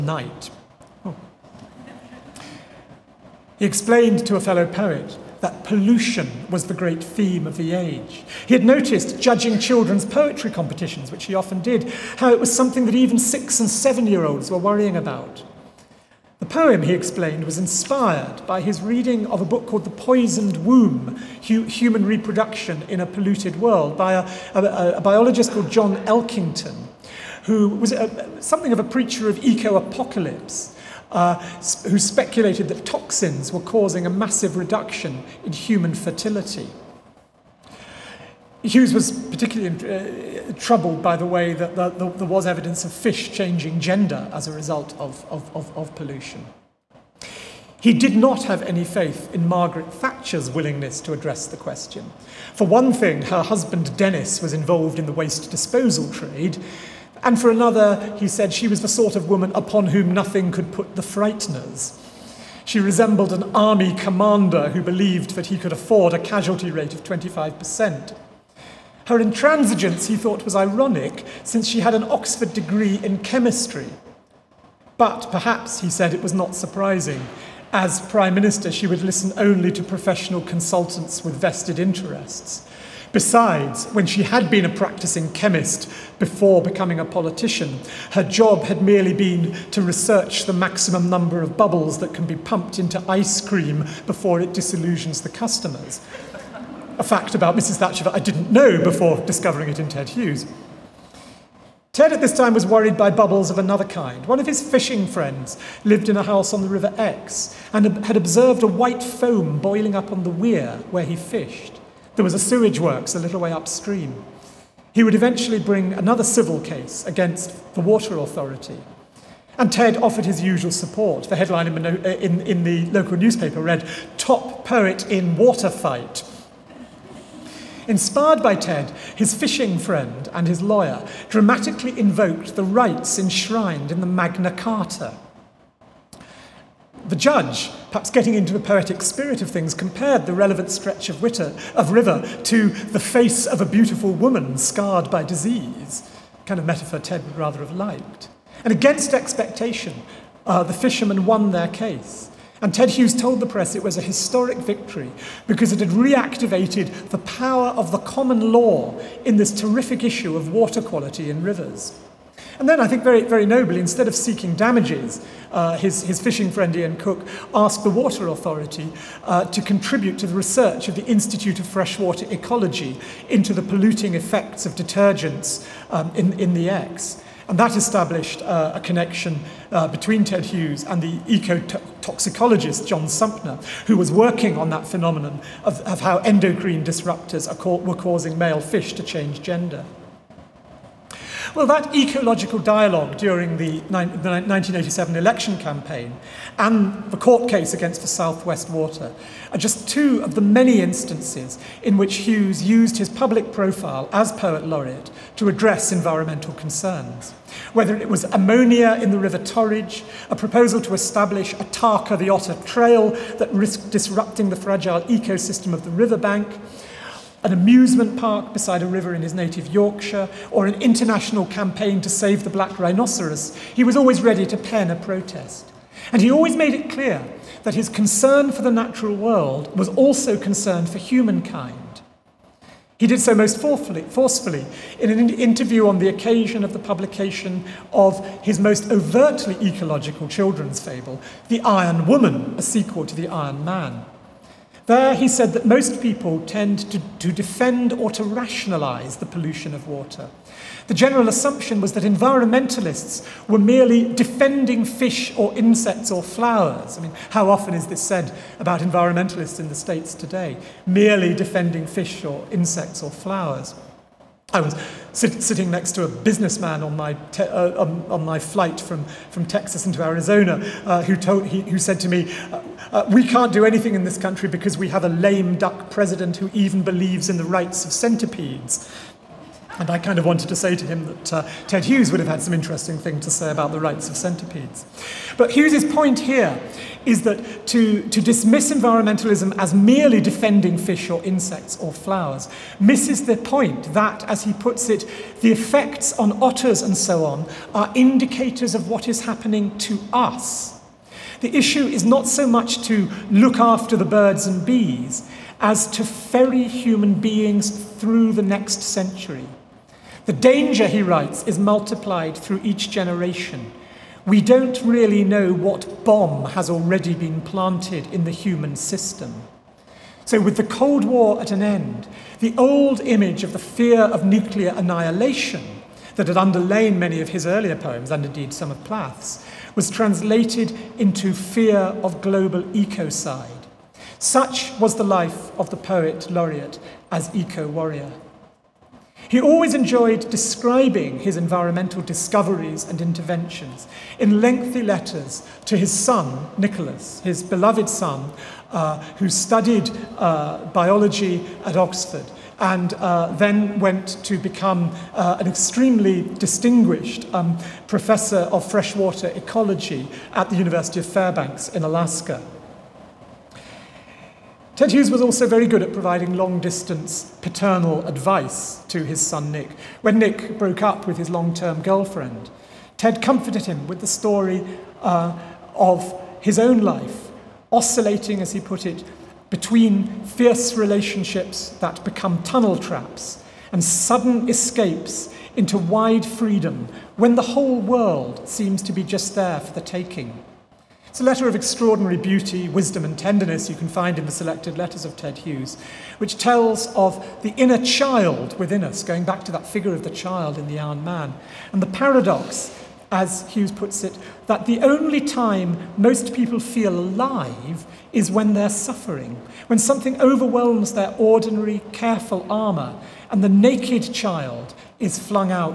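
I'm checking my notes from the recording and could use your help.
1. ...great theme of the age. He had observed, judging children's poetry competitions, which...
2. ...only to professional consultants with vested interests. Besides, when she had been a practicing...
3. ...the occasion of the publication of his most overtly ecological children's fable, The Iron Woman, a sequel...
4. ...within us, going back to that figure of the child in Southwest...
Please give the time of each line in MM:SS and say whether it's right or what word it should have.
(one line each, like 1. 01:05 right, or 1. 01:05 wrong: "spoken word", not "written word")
1. 00:06 wrong: "noticed", not "observed"
2. 01:19 right
3. 03:55 right
4. 06:38 wrong: "The", not "Southwest".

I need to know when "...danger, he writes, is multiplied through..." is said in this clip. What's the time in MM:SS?
05:10.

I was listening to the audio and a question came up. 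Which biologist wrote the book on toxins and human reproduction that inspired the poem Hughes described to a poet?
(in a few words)
John Elkington.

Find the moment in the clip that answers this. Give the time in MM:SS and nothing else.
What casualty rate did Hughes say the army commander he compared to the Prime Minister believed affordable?
01:07.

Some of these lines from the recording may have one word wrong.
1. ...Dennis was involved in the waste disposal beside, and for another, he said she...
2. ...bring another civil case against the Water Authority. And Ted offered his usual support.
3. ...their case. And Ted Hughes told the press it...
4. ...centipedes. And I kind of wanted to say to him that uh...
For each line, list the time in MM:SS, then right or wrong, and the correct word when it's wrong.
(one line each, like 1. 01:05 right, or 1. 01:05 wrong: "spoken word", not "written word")
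1. 00:53 wrong: "trade", not "beside"
2. 01:55 right
3. 02:31 right
4. 04:37 right.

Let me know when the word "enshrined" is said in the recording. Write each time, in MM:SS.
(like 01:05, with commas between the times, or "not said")
02:13.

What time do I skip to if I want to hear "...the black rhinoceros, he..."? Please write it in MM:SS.
03:42.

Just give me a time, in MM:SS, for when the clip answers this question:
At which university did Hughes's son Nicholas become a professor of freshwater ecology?
06:00.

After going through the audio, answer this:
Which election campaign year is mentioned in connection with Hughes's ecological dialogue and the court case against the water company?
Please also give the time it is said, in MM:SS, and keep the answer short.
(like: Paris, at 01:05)
1987, at 03:14.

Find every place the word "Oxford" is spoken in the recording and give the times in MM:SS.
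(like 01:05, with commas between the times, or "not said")
01:12, 05:51.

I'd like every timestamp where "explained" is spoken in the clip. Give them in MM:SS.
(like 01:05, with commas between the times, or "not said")
00:03, 00:16.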